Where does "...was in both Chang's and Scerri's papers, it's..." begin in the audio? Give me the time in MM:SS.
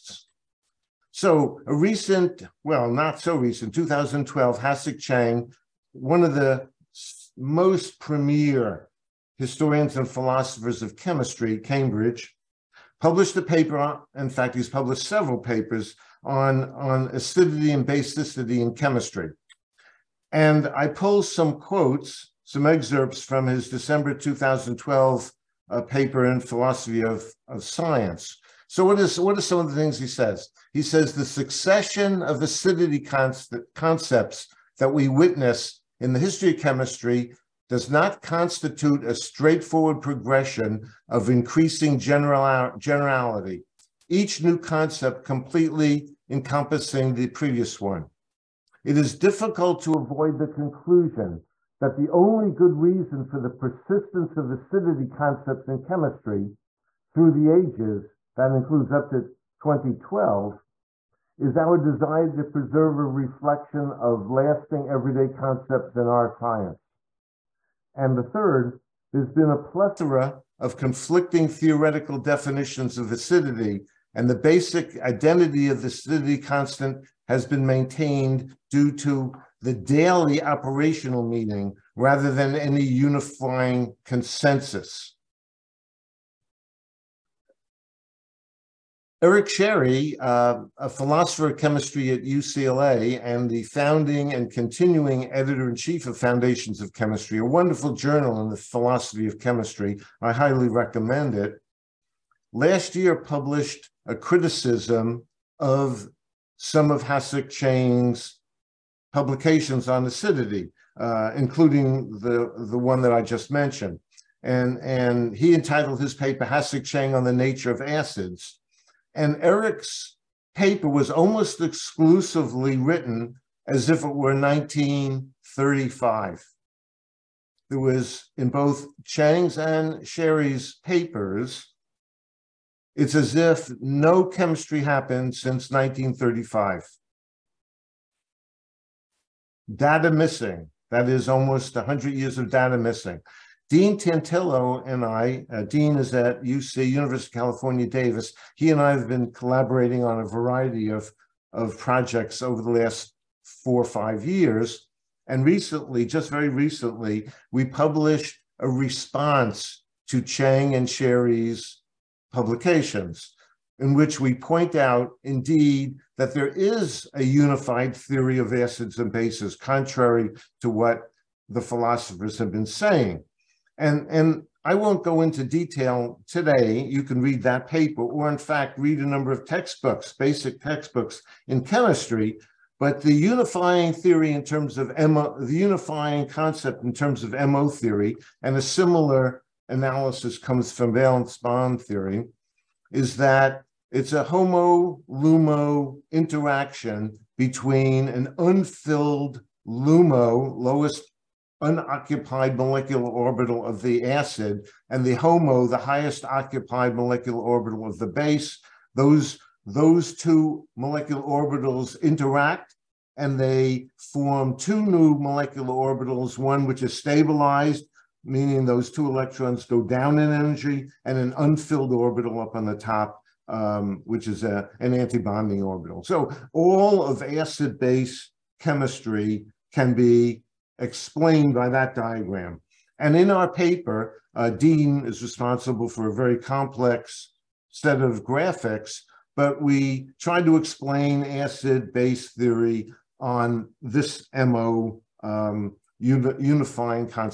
02:07.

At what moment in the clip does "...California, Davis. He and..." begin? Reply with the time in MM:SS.
02:27.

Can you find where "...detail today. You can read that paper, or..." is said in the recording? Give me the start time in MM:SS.
02:55.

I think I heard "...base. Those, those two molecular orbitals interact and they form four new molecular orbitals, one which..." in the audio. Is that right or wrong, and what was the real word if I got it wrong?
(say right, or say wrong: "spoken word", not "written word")
wrong: "two", not "four".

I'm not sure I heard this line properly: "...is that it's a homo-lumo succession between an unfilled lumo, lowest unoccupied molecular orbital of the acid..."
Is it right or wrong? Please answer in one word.
wrong.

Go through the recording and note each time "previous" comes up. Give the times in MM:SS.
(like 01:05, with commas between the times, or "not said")
00:47.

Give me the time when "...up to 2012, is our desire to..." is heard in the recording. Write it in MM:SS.
00:58.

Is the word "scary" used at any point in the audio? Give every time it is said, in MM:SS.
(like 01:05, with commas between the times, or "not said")
not said.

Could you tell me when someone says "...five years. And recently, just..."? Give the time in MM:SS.
02:33.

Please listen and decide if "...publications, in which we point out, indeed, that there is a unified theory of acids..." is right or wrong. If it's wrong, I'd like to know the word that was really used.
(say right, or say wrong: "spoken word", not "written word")
right.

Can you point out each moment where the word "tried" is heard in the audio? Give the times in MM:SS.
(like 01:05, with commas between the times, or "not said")
04:00.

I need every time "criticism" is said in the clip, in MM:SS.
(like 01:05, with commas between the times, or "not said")
01:44.